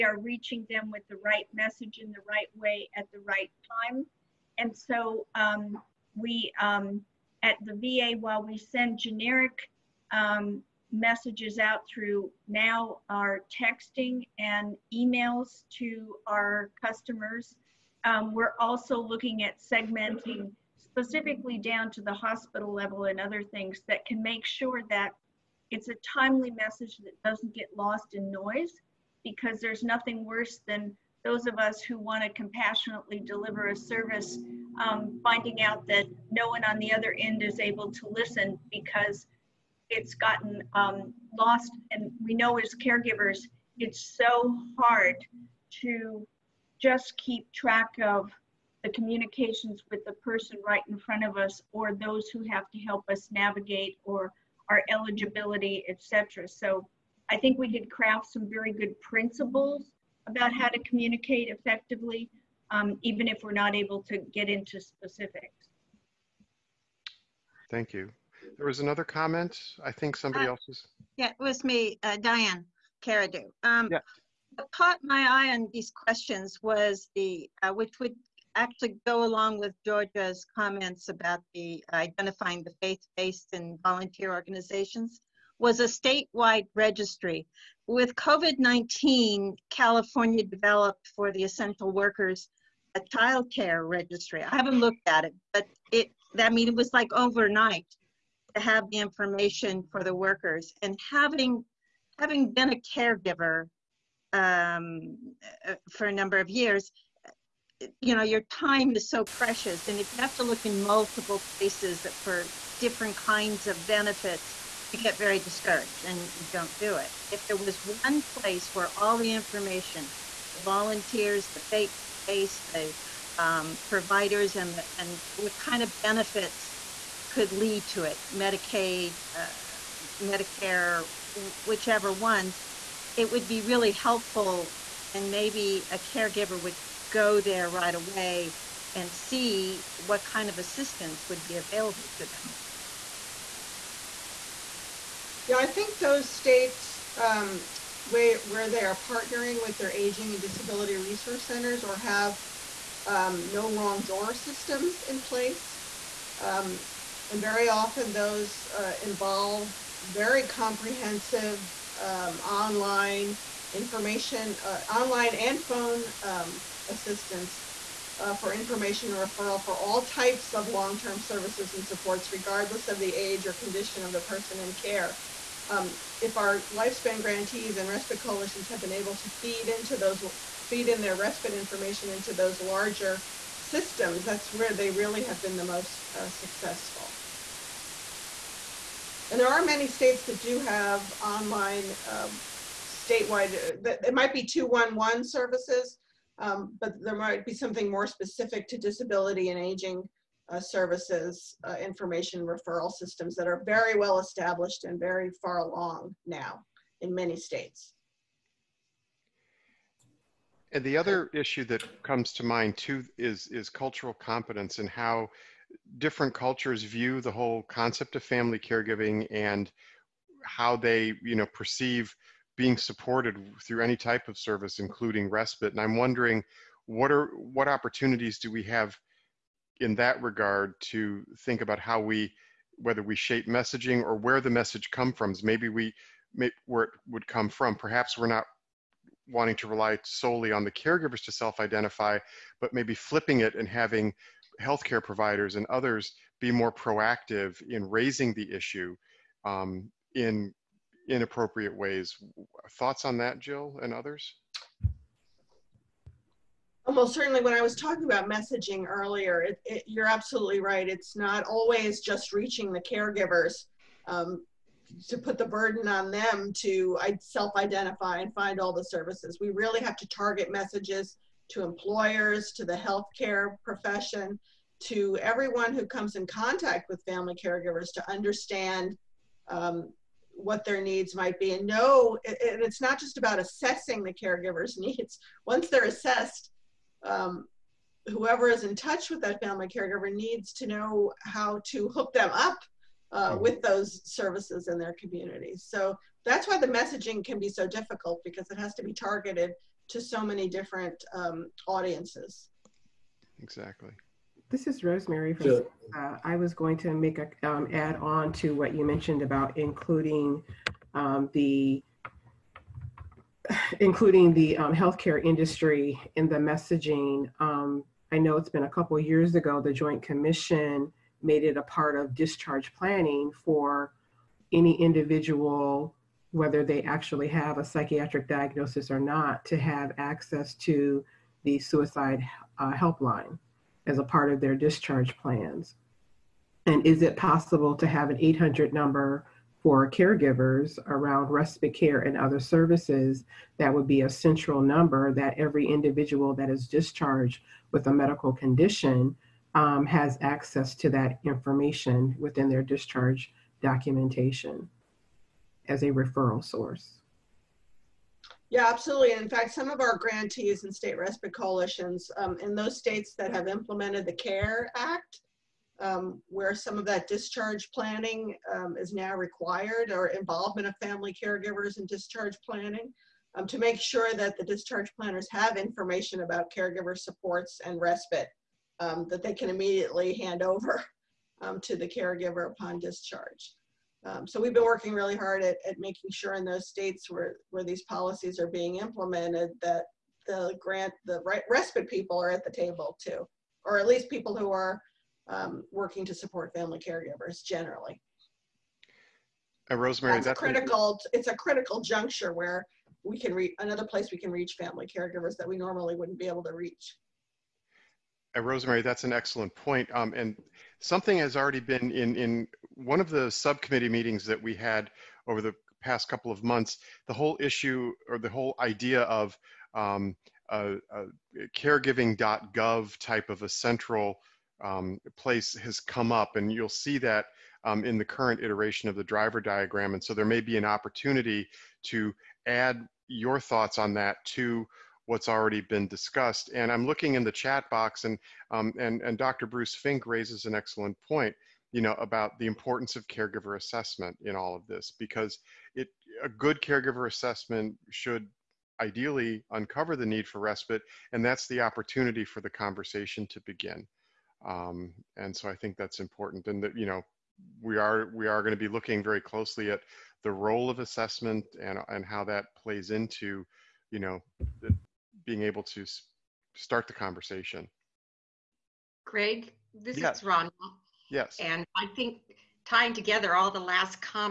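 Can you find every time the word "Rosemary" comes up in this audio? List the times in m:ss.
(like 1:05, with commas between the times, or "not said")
5:04, 6:39, 6:48.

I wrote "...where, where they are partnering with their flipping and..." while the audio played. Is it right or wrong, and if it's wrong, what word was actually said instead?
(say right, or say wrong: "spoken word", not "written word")
wrong: "aging", not "flipping".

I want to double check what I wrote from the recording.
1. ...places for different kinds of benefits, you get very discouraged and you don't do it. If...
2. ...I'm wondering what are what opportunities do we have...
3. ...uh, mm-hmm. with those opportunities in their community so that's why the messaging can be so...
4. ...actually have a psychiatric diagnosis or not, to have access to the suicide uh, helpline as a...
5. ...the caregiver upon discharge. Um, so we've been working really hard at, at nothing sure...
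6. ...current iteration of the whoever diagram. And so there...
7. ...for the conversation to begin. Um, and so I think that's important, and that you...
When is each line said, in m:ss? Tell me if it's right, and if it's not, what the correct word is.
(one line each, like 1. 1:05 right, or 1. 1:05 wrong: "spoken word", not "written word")
1. 1:51 right
2. 3:45 right
3. 4:53 wrong: "services", not "opportunities"
4. 5:26 right
5. 6:21 wrong: "making", not "nothing"
6. 7:08 wrong: "driver", not "whoever"
7. 7:32 right.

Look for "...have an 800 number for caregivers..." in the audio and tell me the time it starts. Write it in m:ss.
5:37.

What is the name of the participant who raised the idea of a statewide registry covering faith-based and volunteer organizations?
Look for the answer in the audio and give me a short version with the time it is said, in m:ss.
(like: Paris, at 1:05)
Diane Caradu, at 1:12.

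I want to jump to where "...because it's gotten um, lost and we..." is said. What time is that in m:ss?
0:38.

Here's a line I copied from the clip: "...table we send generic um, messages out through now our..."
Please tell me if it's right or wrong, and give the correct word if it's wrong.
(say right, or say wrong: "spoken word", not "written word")
wrong: "while", not "table".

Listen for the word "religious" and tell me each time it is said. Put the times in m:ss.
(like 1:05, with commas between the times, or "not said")
not said.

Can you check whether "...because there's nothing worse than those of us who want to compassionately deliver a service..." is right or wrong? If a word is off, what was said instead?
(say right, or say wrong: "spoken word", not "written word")
right.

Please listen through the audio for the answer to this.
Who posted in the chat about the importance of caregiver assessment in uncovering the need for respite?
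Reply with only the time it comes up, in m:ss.
7:19.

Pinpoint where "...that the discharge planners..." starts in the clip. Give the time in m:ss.
6:14.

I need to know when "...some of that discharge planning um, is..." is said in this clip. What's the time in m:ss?
6:06.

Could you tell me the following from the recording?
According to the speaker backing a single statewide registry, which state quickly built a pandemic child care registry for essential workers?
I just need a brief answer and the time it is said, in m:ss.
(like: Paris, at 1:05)
California, at 1:29.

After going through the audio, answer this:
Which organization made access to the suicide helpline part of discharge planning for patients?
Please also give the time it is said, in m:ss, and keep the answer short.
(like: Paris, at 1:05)
The Joint Commission, at 5:19.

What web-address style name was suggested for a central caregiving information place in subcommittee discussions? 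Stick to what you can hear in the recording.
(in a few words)
caregiving.gov.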